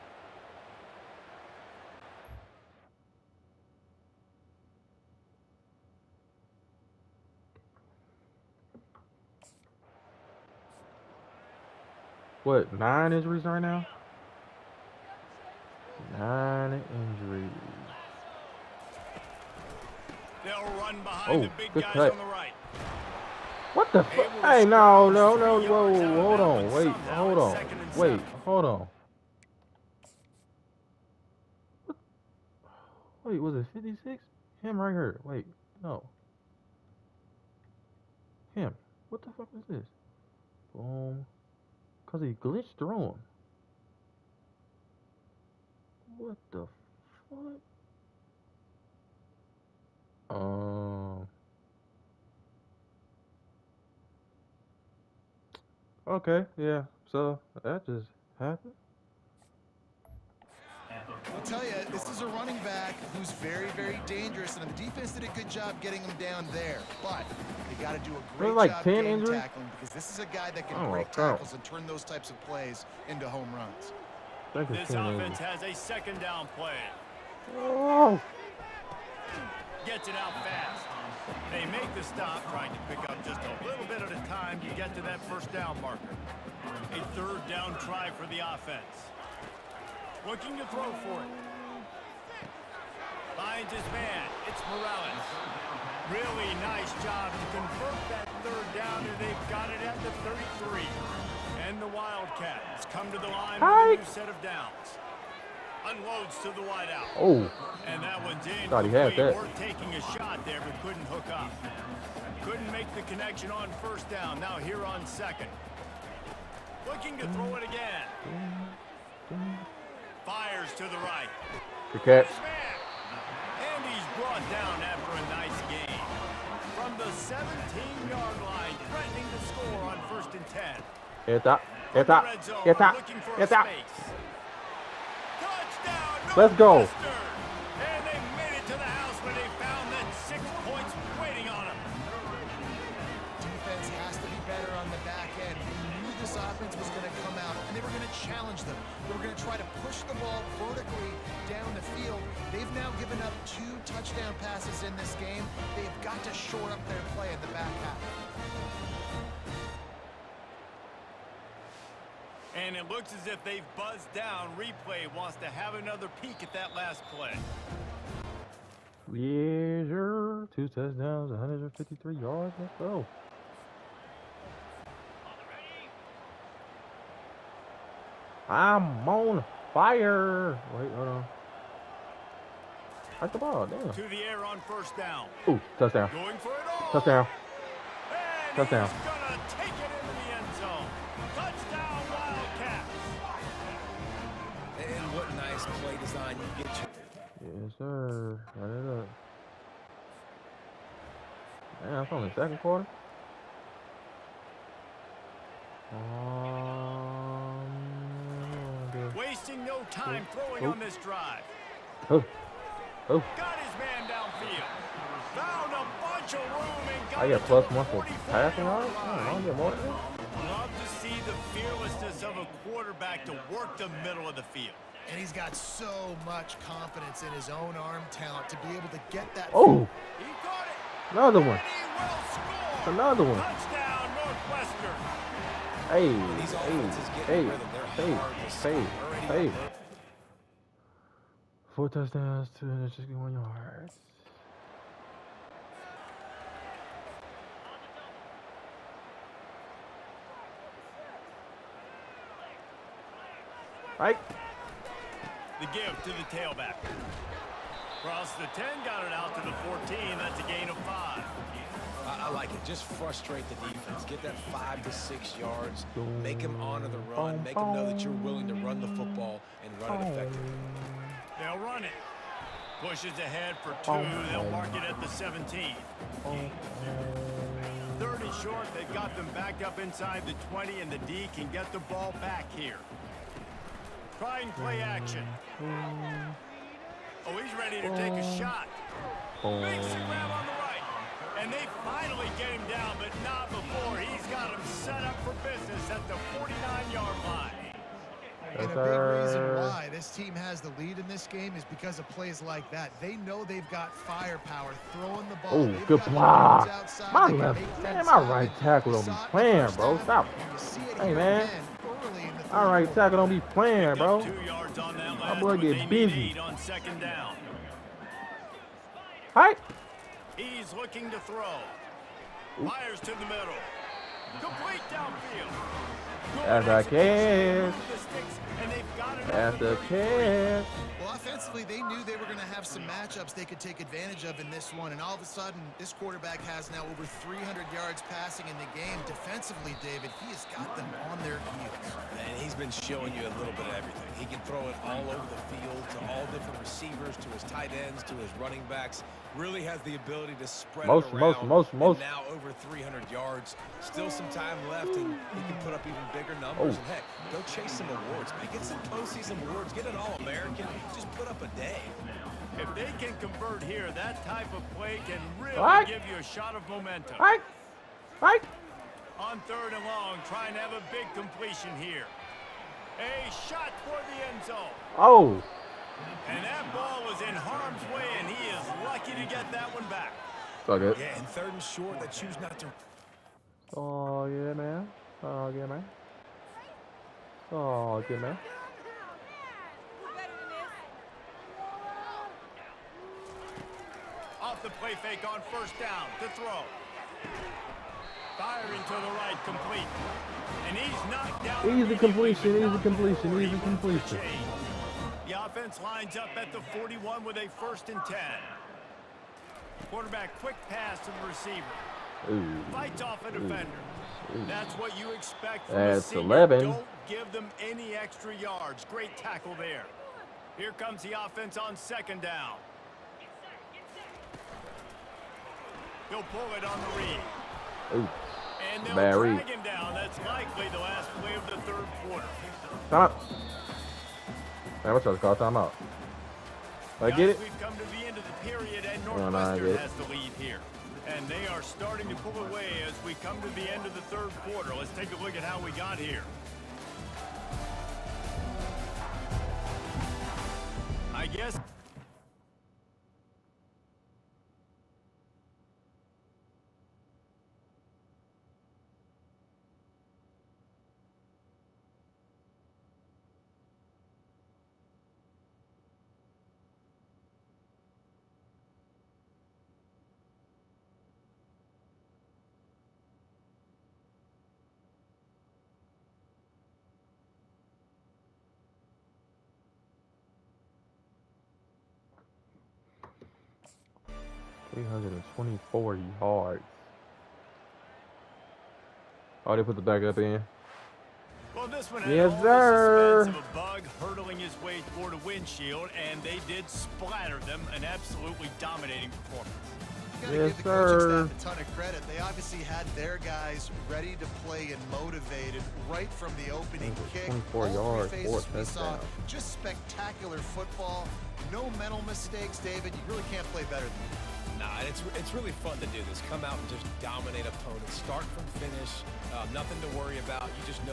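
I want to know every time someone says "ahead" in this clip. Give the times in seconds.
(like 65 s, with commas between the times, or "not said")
273 s.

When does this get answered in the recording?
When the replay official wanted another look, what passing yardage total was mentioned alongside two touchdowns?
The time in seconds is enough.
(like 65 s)
171 s.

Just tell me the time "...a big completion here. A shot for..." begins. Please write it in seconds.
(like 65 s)
370 s.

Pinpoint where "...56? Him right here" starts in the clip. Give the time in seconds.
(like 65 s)
33 s.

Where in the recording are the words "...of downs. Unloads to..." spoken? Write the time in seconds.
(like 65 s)
104 s.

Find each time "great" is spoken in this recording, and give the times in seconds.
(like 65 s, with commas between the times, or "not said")
68 s, 418 s.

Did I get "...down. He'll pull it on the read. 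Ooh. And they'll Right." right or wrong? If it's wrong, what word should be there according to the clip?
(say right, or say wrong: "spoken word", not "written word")
wrong: "Barry", not "Right".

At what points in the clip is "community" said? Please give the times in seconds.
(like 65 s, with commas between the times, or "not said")
not said.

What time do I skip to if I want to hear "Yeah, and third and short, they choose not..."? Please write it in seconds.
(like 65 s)
380 s.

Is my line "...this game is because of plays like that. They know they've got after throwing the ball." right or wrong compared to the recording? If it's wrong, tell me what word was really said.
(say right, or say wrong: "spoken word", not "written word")
wrong: "firepower", not "after".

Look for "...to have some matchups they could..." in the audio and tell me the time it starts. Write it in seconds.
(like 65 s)
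332 s.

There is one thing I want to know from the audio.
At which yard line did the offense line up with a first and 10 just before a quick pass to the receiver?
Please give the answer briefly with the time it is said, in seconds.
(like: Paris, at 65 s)
41, at 406 s.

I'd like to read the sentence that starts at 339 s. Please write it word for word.
Defensively, David, he has got them on their heels.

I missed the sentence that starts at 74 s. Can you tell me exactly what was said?
This offense has a second down play.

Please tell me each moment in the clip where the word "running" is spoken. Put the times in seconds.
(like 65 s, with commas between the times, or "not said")
62 s, 348 s.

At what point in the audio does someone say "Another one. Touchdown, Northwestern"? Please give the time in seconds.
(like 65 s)
232 s.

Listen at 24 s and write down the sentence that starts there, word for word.
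Hey, no, no, no, whoa, whoa, hold on, wait, hold on, wait, hold on.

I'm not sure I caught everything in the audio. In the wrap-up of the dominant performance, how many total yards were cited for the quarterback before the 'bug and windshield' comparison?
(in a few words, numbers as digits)
324.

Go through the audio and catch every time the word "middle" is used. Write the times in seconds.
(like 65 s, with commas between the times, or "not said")
224 s, 323 s.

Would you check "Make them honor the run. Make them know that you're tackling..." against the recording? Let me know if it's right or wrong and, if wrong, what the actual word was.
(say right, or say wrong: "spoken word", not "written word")
wrong: "willing", not "tackling".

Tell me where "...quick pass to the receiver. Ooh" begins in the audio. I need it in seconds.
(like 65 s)
410 s.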